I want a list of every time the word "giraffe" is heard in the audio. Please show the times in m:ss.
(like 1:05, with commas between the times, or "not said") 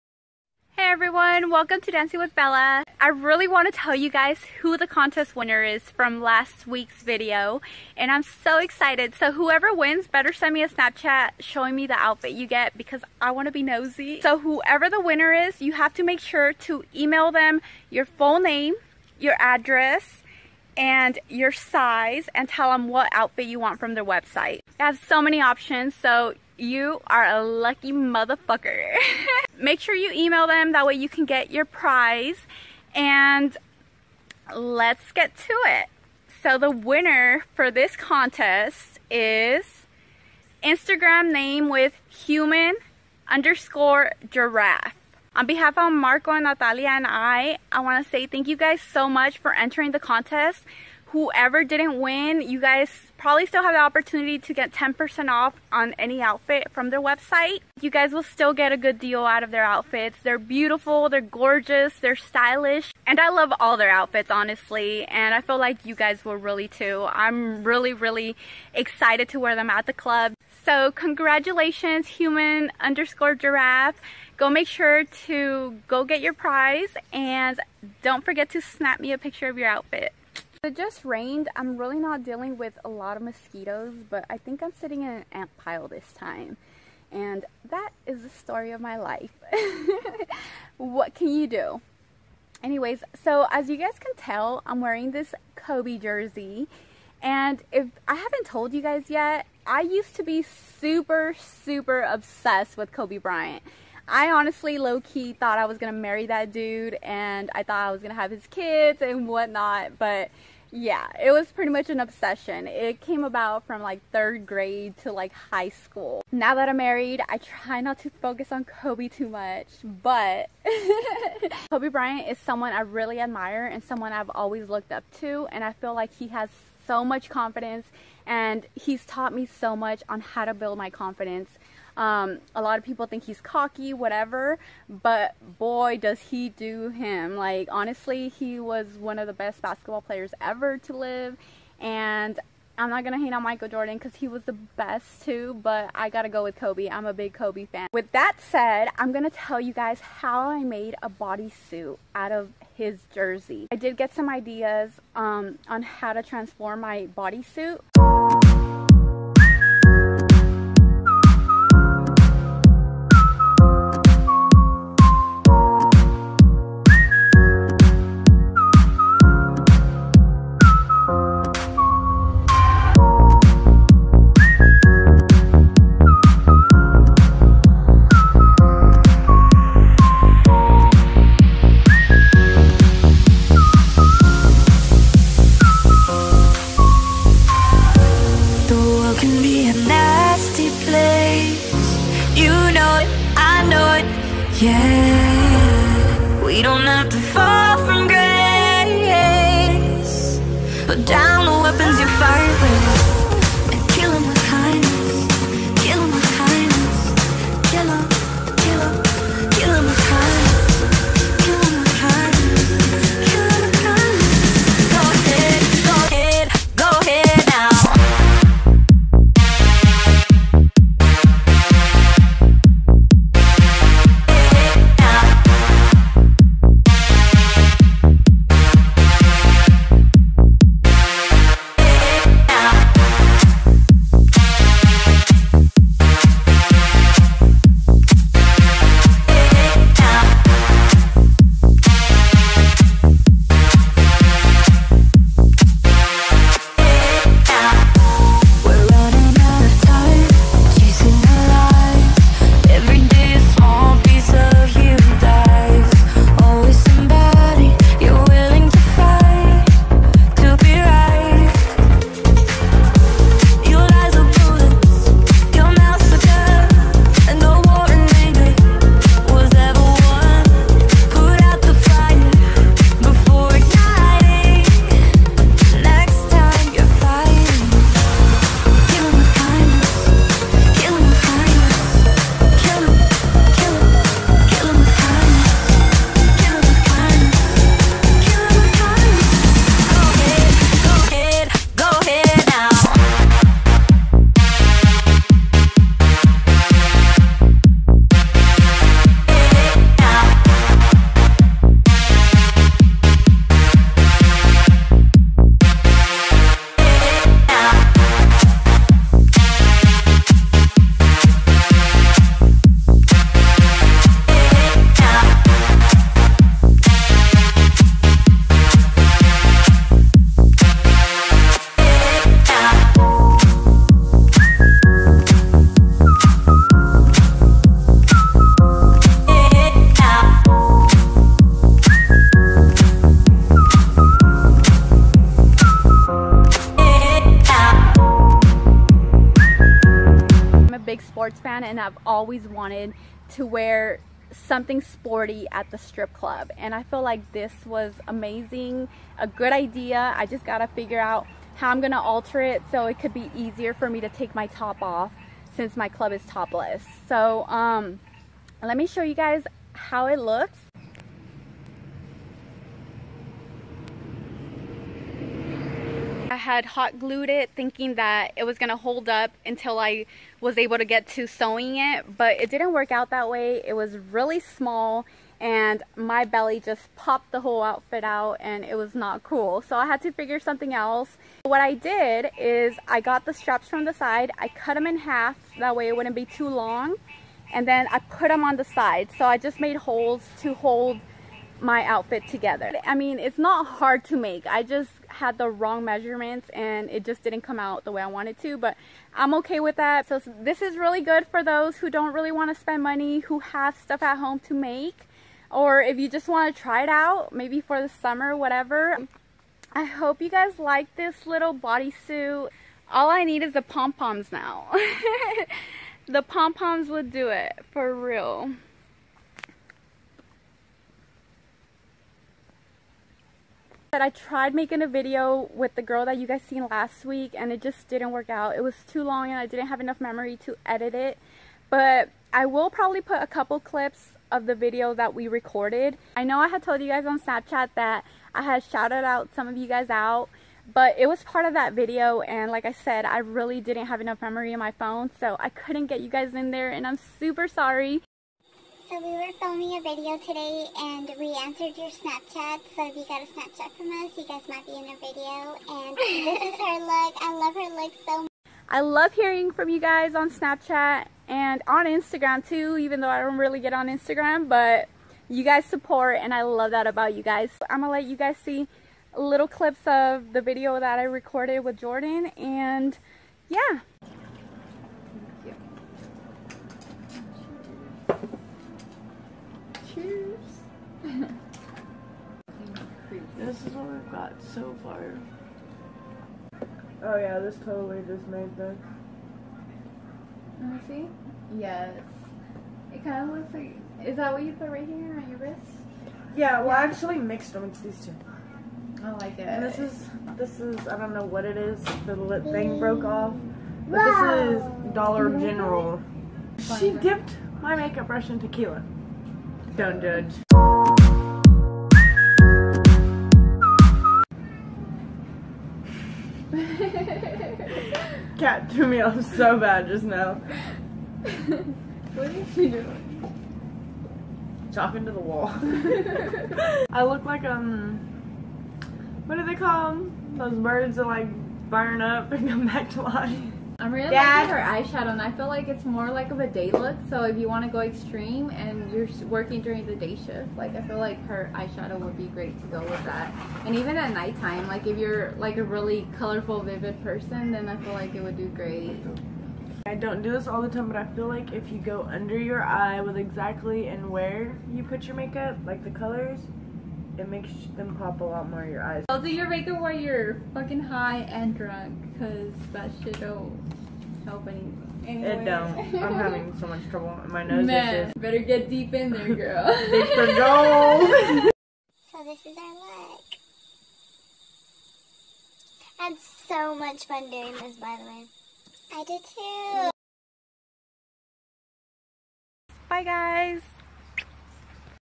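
0:44, 1:13.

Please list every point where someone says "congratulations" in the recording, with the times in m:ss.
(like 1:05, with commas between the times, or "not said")
1:10.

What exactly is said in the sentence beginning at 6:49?
I hope you guys like this little bodysuit.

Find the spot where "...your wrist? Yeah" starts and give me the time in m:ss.
8:15.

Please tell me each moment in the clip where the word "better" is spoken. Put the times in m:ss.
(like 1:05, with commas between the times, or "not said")
0:10, 9:28.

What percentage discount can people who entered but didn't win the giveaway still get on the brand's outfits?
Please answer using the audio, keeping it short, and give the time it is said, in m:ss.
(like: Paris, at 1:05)
10%, at 0:54.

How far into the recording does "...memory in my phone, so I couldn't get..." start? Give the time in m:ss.
7:24.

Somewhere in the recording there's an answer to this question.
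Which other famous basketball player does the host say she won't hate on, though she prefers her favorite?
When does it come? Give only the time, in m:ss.
2:23.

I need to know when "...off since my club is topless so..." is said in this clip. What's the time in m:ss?
5:54.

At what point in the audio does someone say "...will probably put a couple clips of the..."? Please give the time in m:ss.
7:12.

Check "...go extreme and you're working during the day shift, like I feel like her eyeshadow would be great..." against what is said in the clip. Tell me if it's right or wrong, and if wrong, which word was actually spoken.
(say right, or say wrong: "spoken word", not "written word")
right.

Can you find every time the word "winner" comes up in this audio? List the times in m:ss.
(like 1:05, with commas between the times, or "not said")
0:05, 0:15, 0:36.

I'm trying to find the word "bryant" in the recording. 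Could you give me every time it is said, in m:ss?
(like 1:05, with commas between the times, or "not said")
1:43, 2:01.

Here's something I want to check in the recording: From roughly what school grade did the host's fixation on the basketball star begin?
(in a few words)
Third grade.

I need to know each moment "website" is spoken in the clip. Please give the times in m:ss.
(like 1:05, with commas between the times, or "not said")
0:24, 0:57.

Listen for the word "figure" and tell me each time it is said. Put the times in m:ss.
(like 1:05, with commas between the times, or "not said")
5:50, 6:20.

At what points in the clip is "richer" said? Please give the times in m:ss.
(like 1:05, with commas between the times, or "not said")
not said.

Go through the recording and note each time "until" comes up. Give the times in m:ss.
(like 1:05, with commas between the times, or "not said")
6:09.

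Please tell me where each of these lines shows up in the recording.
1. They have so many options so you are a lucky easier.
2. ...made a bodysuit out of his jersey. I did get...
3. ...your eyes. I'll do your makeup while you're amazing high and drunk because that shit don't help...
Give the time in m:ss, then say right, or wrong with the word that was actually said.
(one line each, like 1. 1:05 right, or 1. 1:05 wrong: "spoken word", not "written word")
1. 0:24 wrong: "motherfucker", not "easier"
2. 2:30 right
3. 9:18 wrong: "fucking", not "amazing".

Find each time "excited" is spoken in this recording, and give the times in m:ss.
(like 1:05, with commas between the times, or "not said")
0:08, 1:08.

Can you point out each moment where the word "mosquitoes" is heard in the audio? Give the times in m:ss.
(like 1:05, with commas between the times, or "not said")
1:23.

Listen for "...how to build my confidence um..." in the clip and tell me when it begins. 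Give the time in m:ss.
2:10.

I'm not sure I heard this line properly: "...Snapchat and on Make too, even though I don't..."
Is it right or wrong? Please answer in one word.
wrong.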